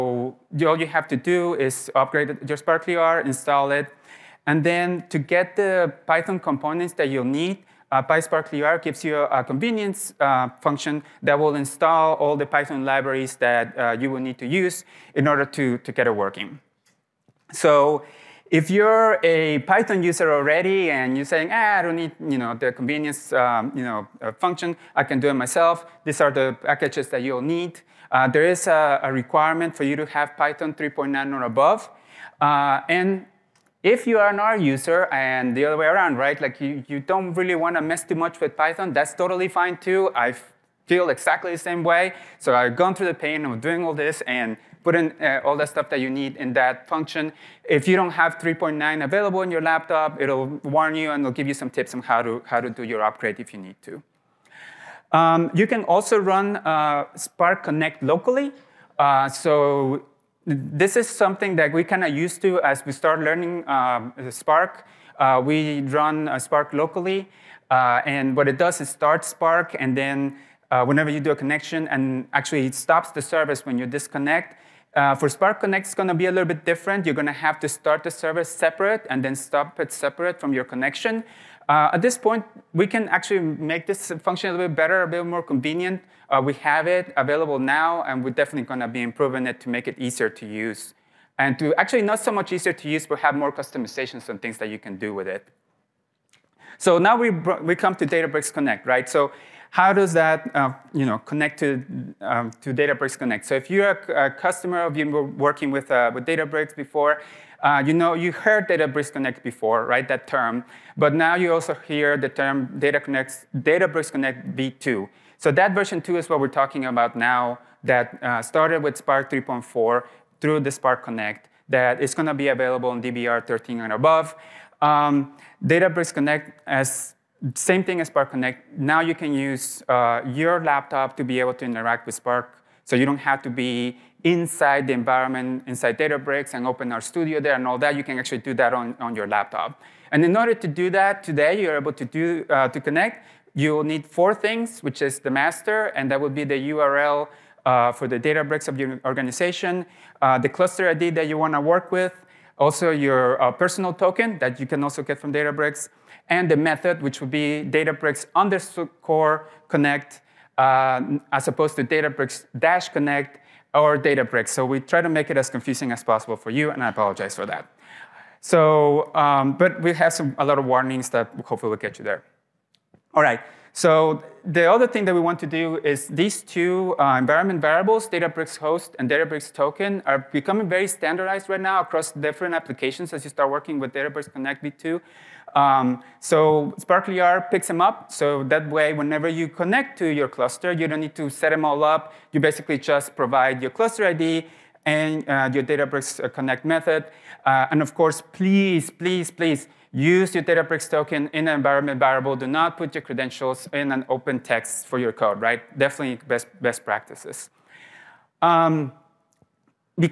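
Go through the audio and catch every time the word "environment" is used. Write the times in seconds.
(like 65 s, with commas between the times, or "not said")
134 s, 177 s, 201 s.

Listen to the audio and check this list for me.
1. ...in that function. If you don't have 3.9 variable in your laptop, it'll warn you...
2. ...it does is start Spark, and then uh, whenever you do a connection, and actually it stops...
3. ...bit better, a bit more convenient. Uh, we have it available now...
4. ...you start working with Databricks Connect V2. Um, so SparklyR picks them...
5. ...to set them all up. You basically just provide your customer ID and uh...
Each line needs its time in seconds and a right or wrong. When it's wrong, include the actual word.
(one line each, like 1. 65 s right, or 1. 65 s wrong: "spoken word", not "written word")
1. 46 s wrong: "available", not "variable"
2. 68 s right
3. 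84 s right
4. 183 s right
5. 191 s wrong: "cluster", not "customer".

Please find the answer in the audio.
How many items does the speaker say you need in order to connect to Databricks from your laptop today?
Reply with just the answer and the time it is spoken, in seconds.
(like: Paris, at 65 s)
4, at 144 s.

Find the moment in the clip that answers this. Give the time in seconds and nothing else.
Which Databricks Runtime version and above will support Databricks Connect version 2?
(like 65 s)
123 s.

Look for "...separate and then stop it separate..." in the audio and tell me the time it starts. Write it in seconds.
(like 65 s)
78 s.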